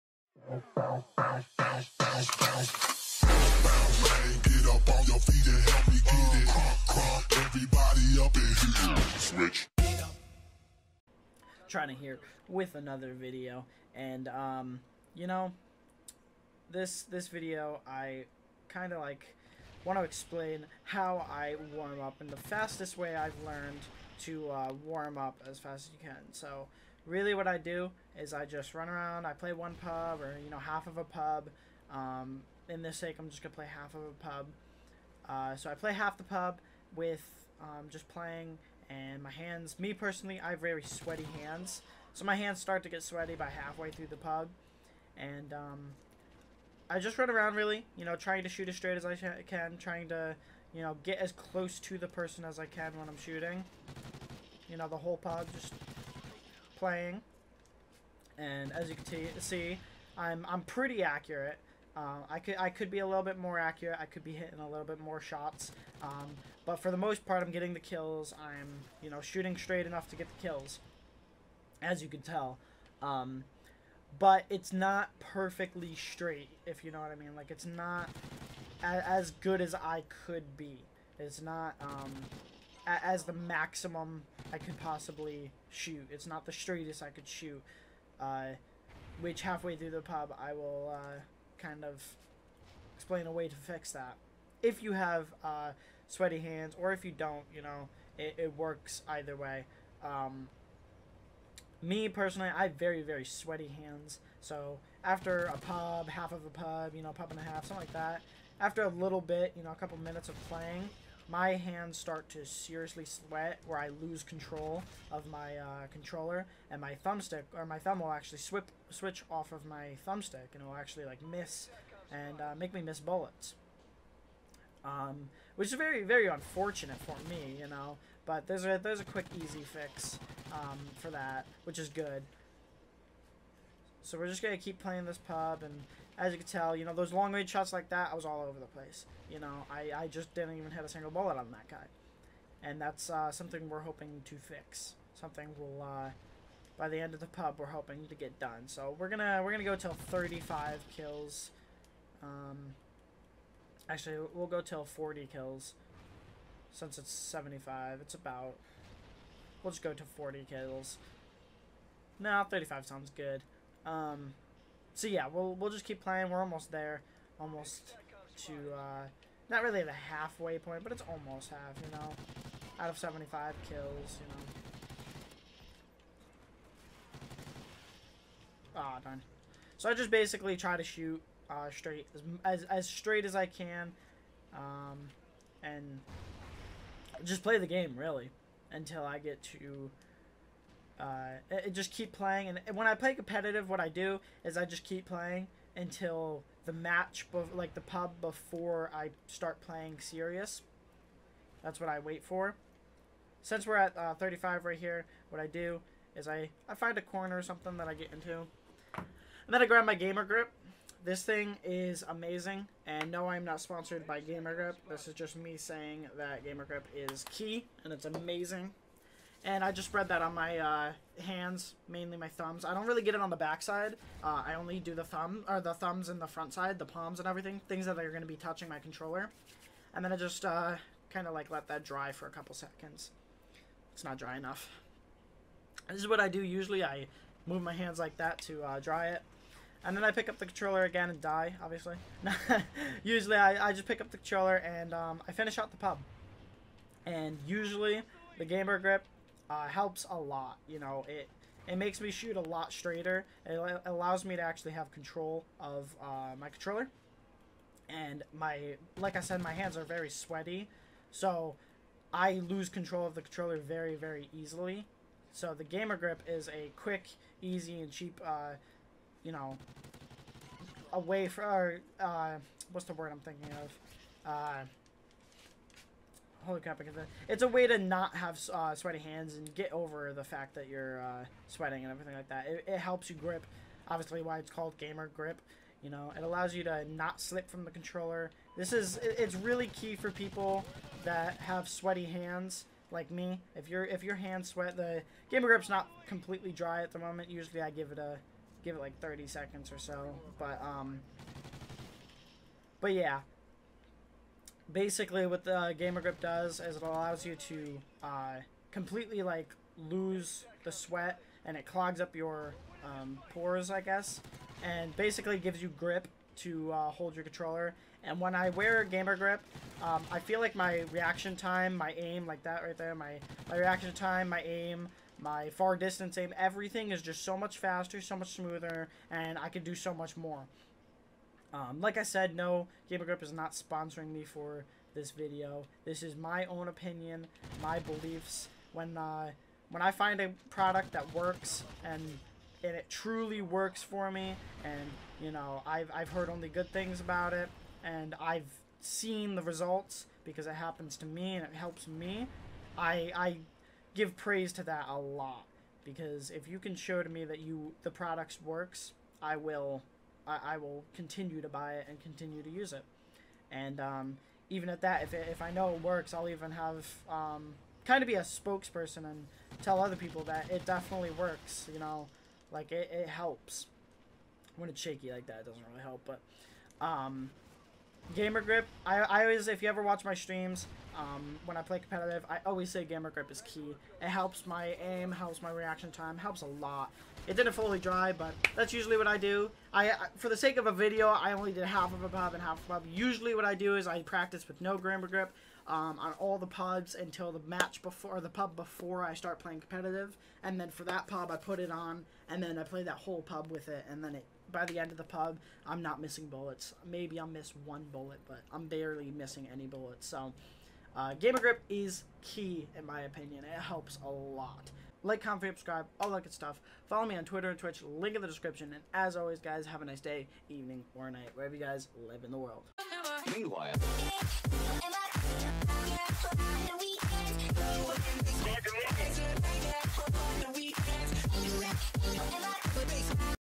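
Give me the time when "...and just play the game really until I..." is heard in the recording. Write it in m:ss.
3:05.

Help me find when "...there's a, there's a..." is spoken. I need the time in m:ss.
2:08.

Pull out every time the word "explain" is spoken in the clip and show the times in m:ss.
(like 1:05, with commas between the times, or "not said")
0:20, 1:32.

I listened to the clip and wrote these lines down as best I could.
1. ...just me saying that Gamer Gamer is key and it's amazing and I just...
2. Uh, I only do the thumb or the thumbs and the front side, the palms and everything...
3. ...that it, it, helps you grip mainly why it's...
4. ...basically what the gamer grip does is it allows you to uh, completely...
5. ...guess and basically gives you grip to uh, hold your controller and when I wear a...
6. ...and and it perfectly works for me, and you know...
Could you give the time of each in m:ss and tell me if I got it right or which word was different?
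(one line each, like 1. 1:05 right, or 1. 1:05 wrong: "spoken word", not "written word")
1. 3:35 wrong: "Grip", not "Gamer"
2. 3:44 right
3. 4:42 wrong: "obviously", not "mainly"
4. 5:04 right
5. 5:13 right
6. 5:41 wrong: "truly", not "perfectly".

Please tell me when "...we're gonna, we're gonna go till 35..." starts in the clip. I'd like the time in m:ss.
2:28.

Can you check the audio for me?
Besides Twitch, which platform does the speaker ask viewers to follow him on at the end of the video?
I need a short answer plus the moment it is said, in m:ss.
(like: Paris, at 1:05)
Twitter, at 6:57.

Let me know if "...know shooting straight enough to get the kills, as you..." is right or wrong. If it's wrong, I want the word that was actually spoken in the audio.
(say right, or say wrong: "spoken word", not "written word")
right.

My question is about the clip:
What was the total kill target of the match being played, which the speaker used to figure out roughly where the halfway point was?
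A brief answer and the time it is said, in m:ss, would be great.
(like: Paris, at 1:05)
75, at 2:36.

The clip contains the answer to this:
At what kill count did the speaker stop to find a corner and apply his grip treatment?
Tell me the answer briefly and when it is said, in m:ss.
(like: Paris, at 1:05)
35, at 3:23.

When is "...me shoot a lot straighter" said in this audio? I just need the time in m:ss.
4:12.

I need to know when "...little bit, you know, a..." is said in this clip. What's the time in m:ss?
1:48.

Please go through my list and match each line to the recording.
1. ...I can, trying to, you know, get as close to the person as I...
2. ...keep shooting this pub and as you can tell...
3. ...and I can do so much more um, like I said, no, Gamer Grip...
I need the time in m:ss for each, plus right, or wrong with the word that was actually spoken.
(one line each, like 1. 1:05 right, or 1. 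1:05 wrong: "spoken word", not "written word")
1. 0:49 right
2. 2:14 wrong: "playing", not "shooting"
3. 5:29 right.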